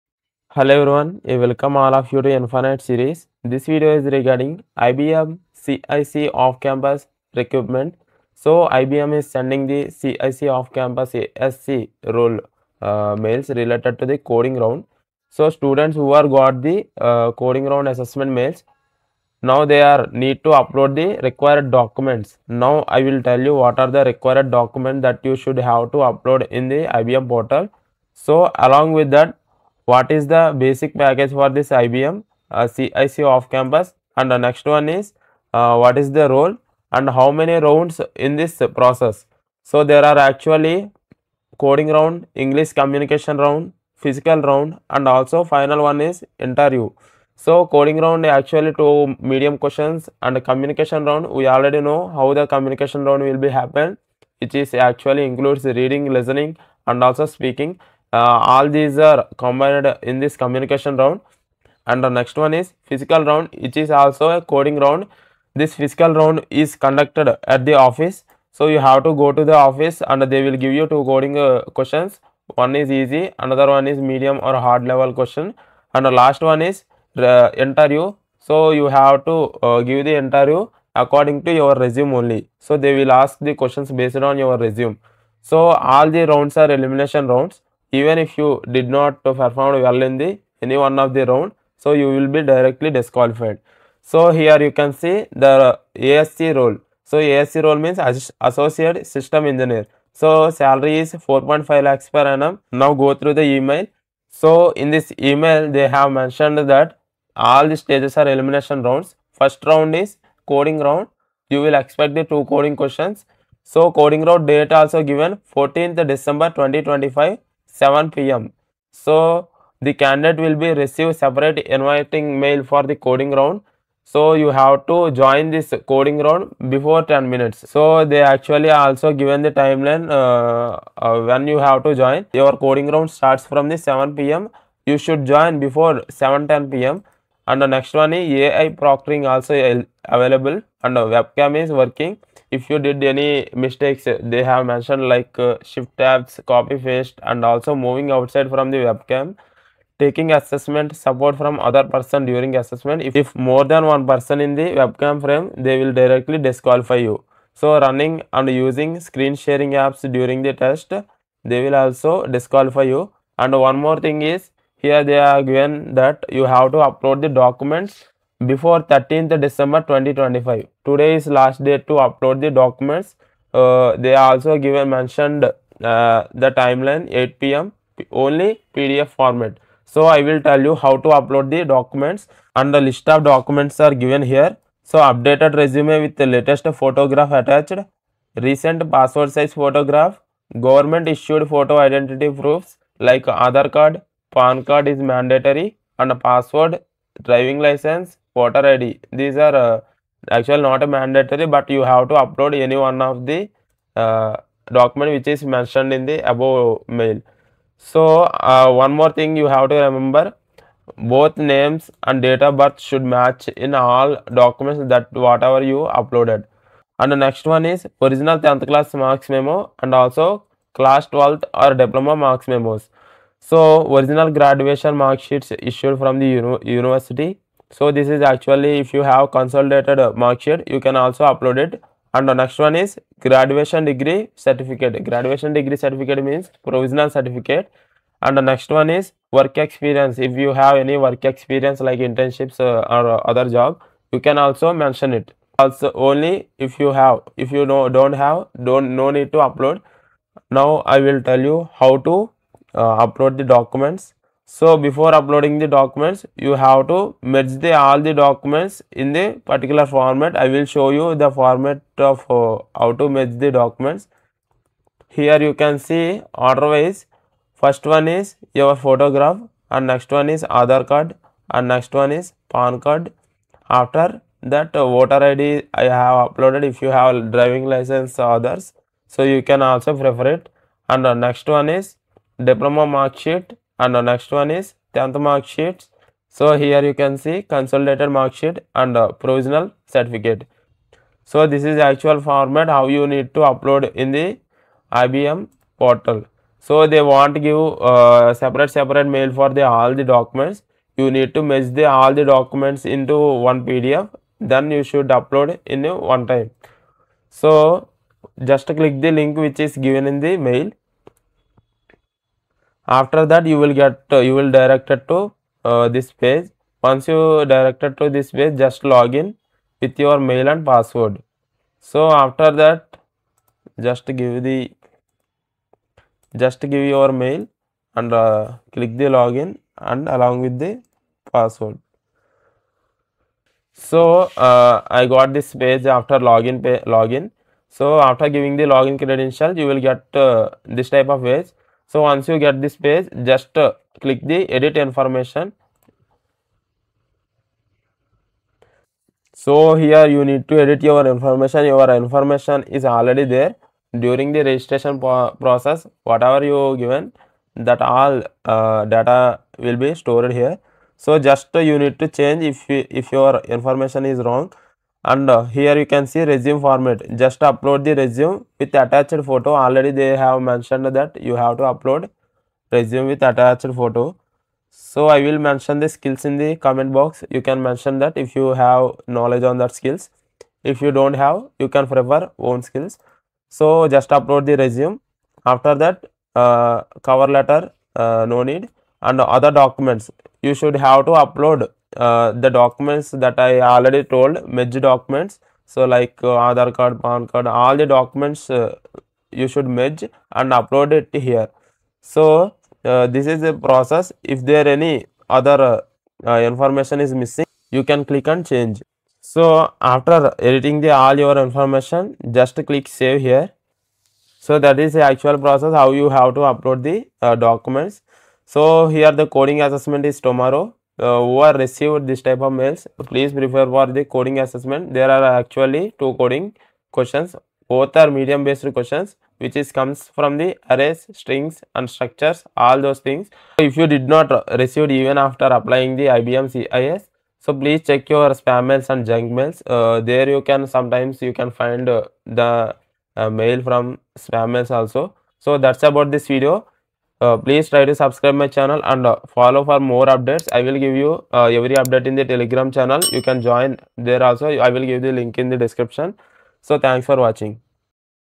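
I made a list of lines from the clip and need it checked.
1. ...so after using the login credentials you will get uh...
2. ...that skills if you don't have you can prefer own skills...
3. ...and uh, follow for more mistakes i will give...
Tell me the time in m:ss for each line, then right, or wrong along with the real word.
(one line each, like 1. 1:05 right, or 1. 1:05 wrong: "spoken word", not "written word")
1. 5:37 wrong: "giving", not "using"
2. 6:19 right
3. 7:28 wrong: "updates", not "mistakes".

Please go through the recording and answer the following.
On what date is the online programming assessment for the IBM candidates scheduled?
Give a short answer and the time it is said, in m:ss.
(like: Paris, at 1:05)
14th December 2025, at 1:55.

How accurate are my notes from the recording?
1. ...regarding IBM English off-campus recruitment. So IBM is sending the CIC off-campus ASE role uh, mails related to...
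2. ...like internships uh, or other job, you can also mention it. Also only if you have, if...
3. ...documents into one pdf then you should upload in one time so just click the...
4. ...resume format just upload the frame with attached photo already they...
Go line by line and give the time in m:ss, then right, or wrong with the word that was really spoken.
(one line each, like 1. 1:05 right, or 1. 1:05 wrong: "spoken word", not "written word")
1. 0:04 wrong: "CIC", not "English"
2. 4:01 right
3. 5:02 right
4. 6:06 wrong: "resume", not "frame".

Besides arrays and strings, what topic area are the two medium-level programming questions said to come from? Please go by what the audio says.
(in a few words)
structures.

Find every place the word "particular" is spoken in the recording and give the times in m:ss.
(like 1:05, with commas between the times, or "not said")
4:19.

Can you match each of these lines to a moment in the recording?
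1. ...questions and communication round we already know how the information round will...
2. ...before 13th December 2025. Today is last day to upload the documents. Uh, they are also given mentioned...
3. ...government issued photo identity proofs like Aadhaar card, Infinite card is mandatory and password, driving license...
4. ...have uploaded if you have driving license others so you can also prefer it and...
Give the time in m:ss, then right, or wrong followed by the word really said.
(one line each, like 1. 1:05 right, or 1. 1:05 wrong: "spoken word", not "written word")
1. 0:49 wrong: "communication", not "information"
2. 2:48 right
3. 3:10 wrong: "PAN", not "Infinite"
4. 4:36 right.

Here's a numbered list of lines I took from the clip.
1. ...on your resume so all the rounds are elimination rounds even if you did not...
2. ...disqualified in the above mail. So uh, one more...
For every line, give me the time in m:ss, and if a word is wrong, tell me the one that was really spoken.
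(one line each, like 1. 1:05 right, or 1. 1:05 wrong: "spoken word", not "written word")
1. 1:24 right
2. 3:25 wrong: "mentioned", not "disqualified".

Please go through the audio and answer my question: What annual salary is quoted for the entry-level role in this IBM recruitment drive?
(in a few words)
4.5 lakhs per annum.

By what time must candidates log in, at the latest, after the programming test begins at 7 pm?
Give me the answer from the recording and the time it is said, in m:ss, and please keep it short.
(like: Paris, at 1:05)
7:10 pm, at 2:16.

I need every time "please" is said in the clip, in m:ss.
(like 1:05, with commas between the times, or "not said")
7:03, 7:17, 7:27.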